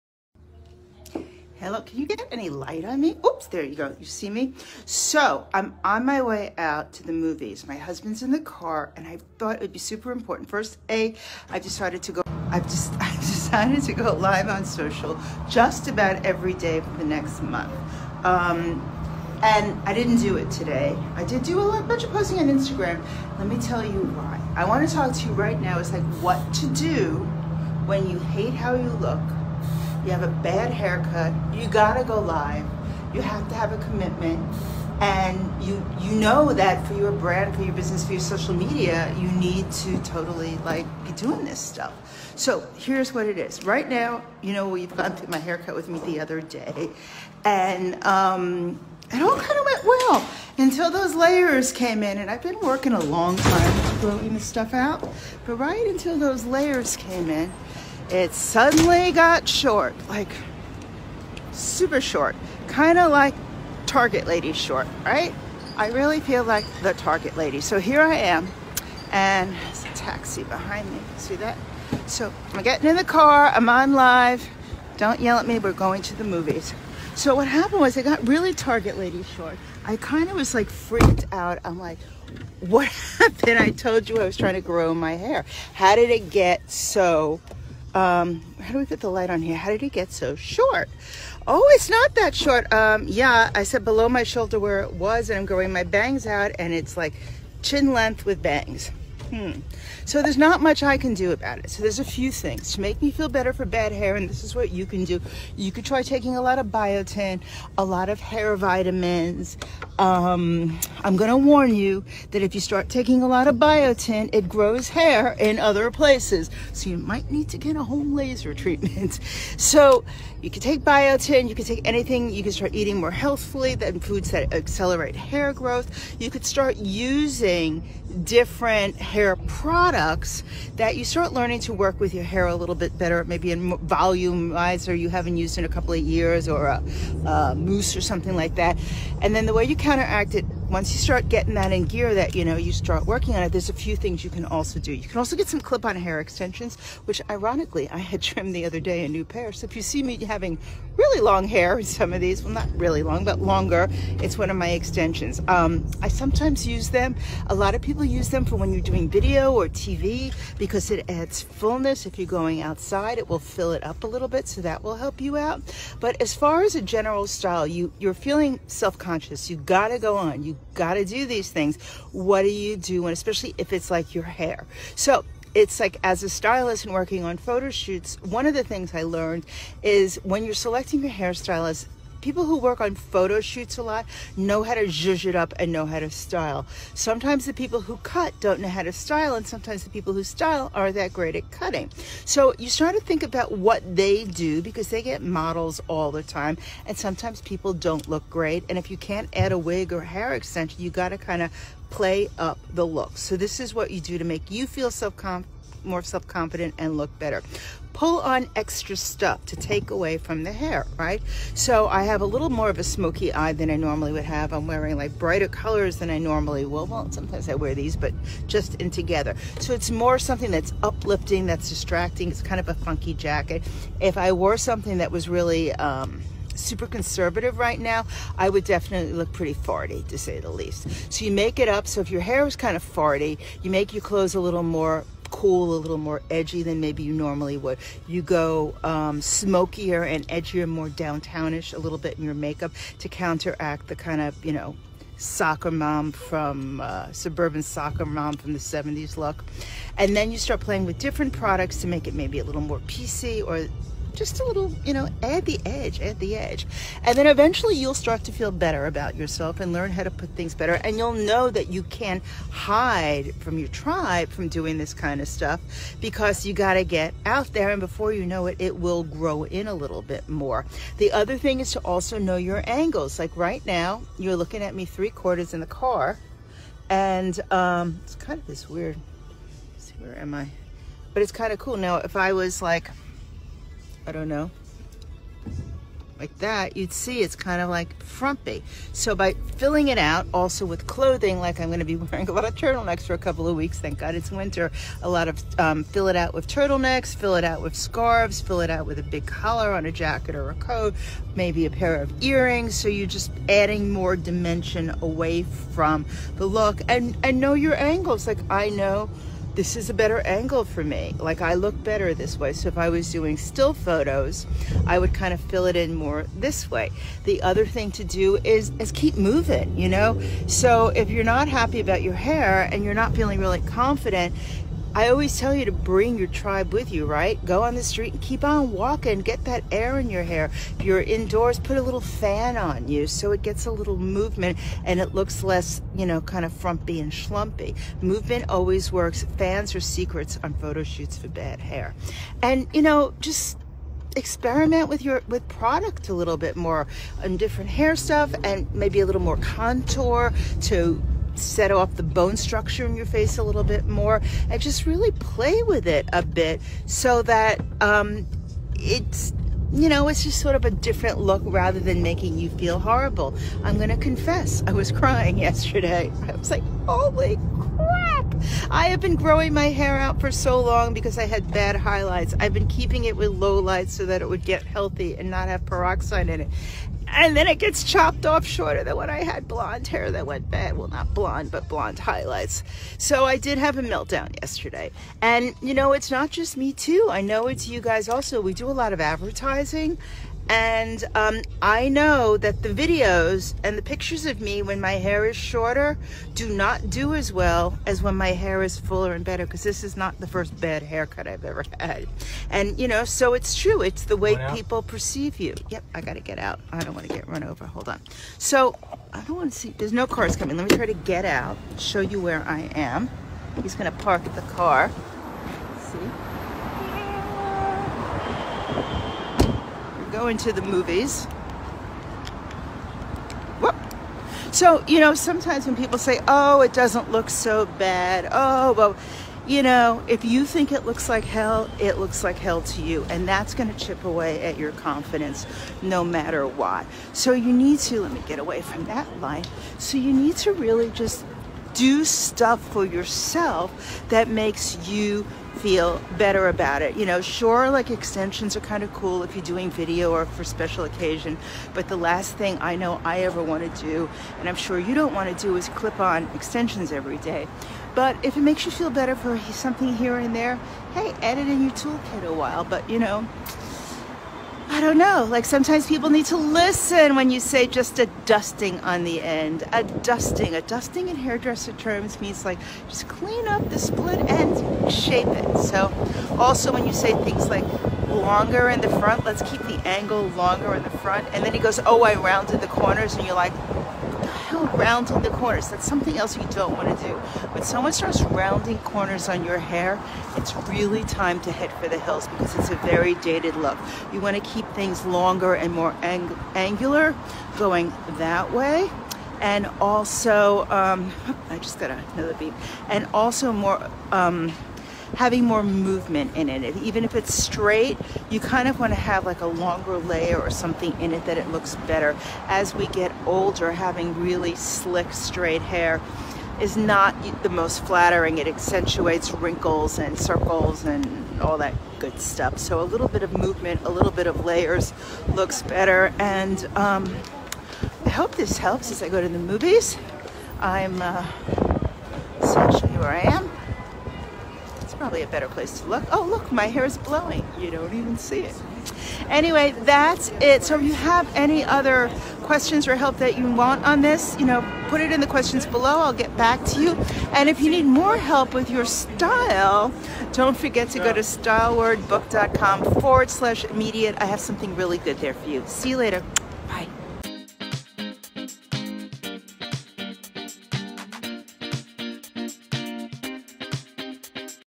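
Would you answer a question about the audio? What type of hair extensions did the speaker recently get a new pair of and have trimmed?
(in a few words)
clip-on.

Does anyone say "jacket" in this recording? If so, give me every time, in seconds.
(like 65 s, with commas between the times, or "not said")
223 s, 299 s.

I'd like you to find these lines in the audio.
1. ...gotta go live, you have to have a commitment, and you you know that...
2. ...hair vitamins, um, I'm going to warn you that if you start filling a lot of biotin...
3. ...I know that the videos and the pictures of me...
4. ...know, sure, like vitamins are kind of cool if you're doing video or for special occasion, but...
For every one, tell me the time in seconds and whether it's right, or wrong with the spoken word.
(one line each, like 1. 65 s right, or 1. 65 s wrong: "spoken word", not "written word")
1. 31 s right
2. 108 s wrong: "taking", not "filling"
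3. 391 s right
4. 447 s wrong: "extensions", not "vitamins".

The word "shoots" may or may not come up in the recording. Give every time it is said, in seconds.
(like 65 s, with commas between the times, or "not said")
177 s, 183 s, 340 s.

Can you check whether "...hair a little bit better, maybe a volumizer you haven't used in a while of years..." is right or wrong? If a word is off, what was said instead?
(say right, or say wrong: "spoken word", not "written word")
wrong: "couple", not "while".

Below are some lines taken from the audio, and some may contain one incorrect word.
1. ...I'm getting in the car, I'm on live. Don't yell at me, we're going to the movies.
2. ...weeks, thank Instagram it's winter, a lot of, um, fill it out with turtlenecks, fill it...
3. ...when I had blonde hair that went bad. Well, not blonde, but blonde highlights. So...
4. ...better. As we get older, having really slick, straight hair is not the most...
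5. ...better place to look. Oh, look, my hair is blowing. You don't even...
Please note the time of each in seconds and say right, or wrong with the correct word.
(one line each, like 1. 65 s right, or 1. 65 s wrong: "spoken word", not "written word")
1. 72 s right
2. 293 s wrong: "God", not "Instagram"
3. 378 s right
4. 511 s right
5. 535 s right.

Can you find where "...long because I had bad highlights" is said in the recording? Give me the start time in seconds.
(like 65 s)
370 s.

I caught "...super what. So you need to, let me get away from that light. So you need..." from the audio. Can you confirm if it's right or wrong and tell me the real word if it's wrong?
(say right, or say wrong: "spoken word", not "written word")
wrong: "matter", not "super".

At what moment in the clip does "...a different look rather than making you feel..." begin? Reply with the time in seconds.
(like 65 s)
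360 s.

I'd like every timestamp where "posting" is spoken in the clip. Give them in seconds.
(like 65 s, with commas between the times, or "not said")
22 s.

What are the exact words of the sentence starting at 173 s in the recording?
And especially if it's like your hair.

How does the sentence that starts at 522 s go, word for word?
So a little bit of movement, a little bit of layers looks better.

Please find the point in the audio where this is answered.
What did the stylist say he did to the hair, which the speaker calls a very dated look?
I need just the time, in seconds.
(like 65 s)
482 s.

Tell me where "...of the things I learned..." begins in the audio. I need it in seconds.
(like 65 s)
178 s.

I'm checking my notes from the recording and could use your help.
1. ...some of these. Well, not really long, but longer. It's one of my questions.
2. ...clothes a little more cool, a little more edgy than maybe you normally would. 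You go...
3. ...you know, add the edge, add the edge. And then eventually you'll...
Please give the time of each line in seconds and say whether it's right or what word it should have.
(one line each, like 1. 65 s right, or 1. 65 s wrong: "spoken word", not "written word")
1. 151 s wrong: "extensions", not "questions"
2. 234 s right
3. 254 s right.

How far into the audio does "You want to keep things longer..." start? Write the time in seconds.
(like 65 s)
494 s.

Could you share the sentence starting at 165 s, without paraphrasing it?
But as far as a general style, you, you're feeling self-conscious.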